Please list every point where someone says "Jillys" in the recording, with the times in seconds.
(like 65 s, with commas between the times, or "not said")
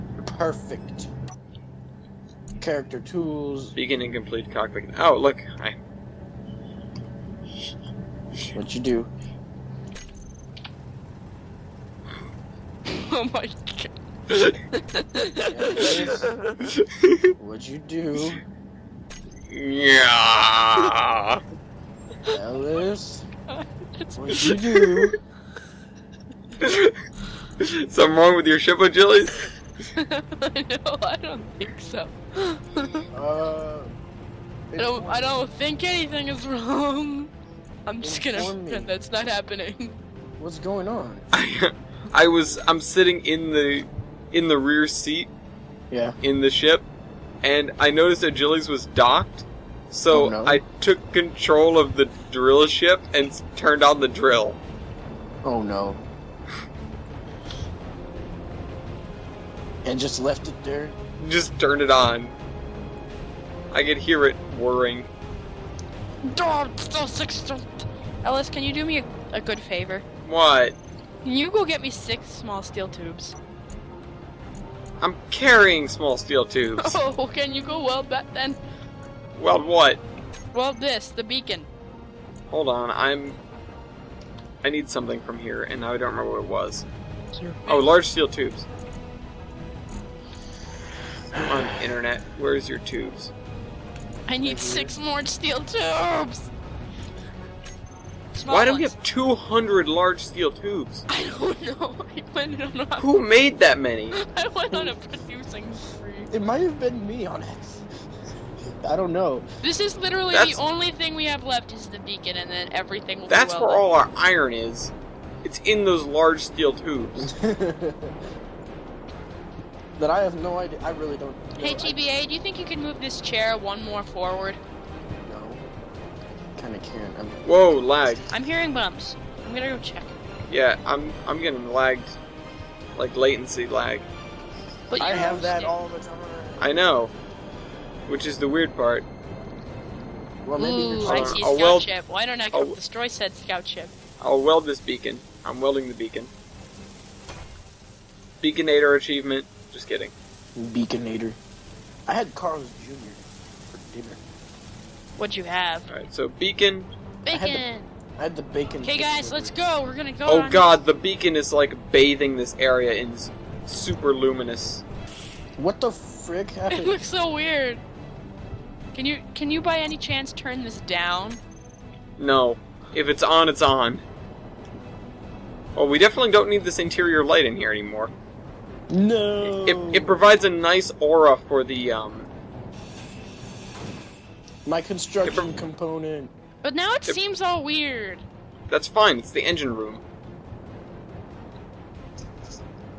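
48 s.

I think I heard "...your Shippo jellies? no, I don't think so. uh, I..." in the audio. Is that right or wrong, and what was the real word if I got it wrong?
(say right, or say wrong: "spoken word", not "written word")
right.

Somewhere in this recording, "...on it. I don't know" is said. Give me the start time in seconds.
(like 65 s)
107 s.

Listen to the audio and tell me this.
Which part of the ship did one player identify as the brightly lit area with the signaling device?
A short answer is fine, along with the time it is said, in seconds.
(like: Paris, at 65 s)
The engine room, at 189 s.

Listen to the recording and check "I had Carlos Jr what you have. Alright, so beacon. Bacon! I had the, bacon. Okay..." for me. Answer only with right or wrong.
right.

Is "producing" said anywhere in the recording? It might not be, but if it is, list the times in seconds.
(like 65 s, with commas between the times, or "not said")
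104 s.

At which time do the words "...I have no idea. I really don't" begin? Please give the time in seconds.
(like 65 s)
120 s.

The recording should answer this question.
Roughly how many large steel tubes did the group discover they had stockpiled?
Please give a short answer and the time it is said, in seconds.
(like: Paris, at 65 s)
200, at 99 s.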